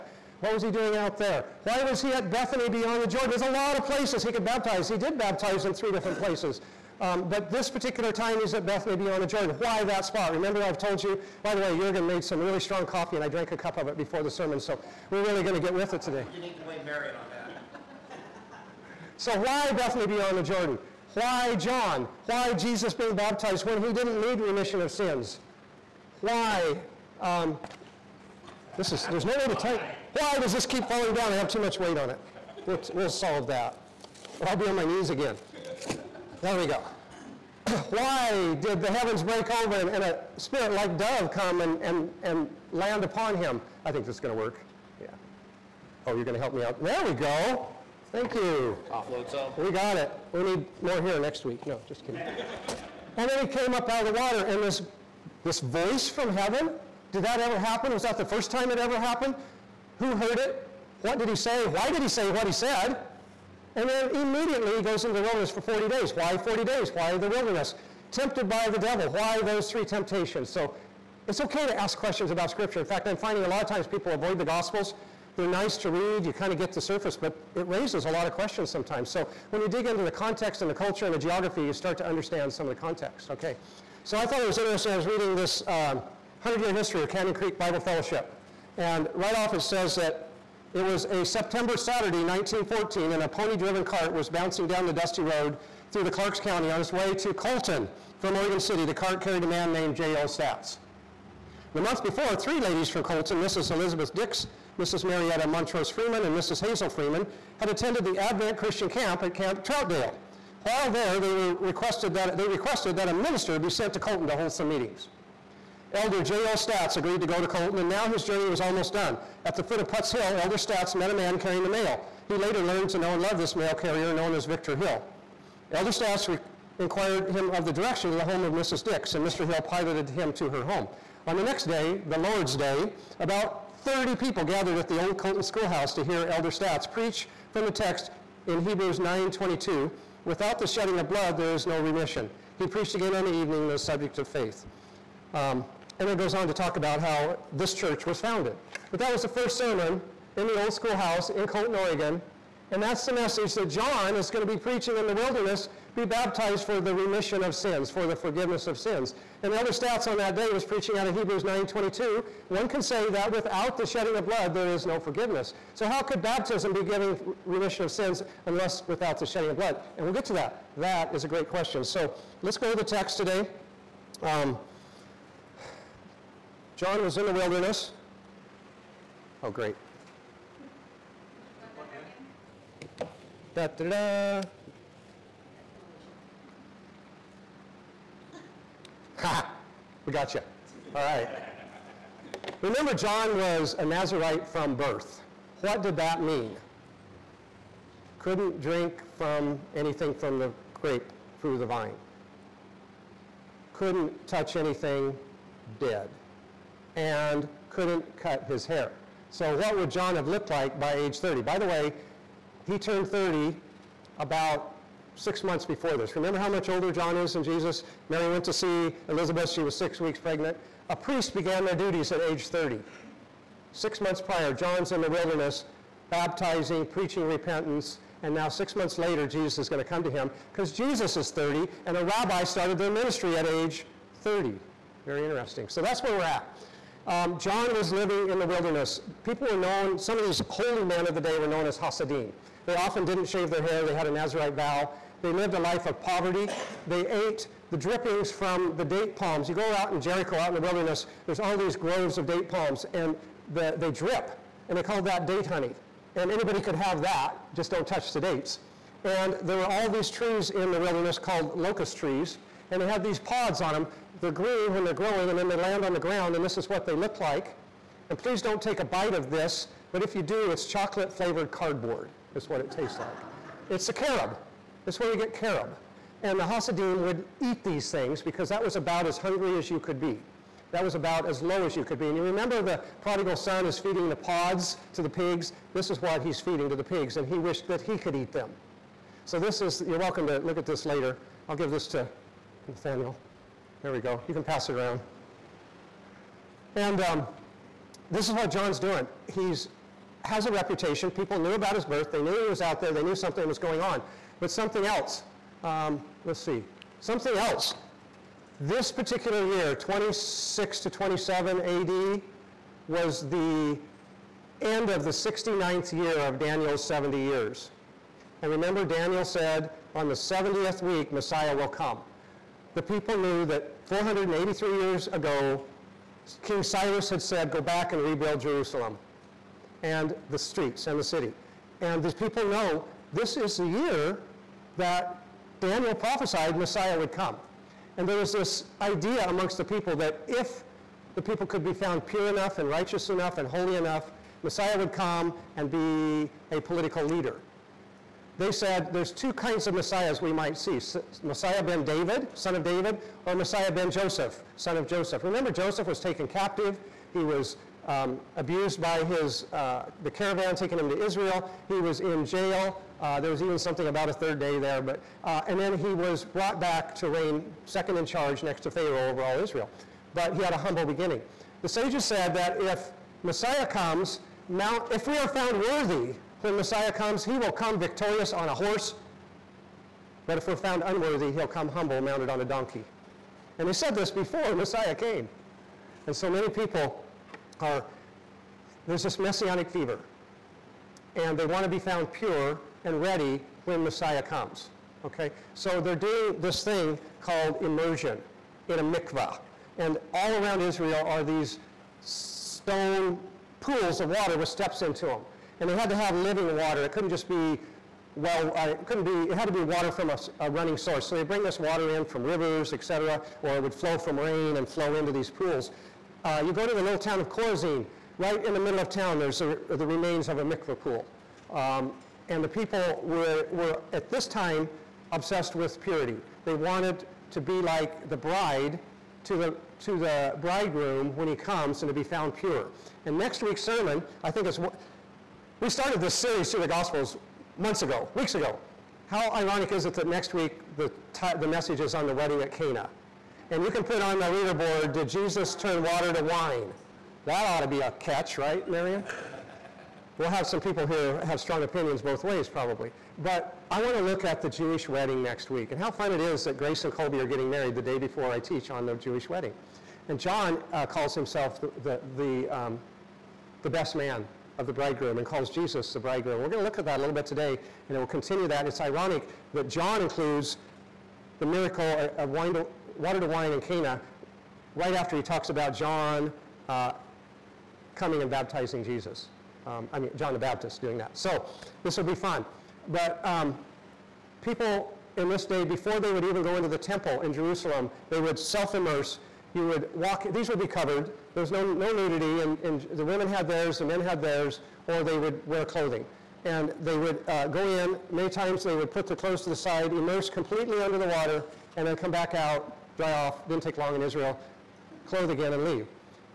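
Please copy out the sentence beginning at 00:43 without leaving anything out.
I think this is going to work.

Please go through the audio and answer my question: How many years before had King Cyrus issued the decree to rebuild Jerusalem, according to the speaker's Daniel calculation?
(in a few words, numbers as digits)
483.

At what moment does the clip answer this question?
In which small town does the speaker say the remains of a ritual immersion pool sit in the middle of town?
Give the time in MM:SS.
06:57.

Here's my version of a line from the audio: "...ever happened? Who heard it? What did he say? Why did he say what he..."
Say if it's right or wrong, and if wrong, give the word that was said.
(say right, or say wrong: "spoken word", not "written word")
right.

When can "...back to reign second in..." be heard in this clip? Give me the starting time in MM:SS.
06:06.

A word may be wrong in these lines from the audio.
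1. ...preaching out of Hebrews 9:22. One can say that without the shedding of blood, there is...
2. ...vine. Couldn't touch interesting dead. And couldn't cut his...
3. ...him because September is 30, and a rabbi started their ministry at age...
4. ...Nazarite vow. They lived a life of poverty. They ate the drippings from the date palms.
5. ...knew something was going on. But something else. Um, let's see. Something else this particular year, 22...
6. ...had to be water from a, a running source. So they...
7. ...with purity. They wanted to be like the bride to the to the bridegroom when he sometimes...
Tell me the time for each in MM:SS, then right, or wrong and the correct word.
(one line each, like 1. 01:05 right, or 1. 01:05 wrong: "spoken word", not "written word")
1. 02:40 right
2. 03:21 wrong: "anything", not "interesting"
3. 03:50 wrong: "Jesus", not "September"
4. 04:04 right
5. 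05:03 wrong: "26", not "22"
6. 06:49 right
7. 07:05 wrong: "comes", not "sometimes".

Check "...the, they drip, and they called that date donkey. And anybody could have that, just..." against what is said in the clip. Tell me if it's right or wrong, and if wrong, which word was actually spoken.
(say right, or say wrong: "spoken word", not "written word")
wrong: "honey", not "donkey".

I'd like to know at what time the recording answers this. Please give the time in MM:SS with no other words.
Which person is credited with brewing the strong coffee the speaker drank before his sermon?
00:11.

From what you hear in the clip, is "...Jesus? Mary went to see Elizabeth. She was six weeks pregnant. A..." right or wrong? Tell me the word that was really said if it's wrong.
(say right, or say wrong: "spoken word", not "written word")
right.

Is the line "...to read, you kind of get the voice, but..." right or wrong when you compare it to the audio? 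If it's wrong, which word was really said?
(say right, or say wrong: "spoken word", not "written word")
wrong: "surface", not "voice".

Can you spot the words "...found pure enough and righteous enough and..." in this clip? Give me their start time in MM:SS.
05:41.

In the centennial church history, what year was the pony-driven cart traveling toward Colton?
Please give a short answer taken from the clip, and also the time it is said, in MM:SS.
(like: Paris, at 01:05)
1914, at 01:32.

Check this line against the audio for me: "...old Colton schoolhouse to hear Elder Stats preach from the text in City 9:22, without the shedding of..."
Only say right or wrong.
wrong.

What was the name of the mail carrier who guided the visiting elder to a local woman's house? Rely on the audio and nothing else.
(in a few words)
Victor Hill.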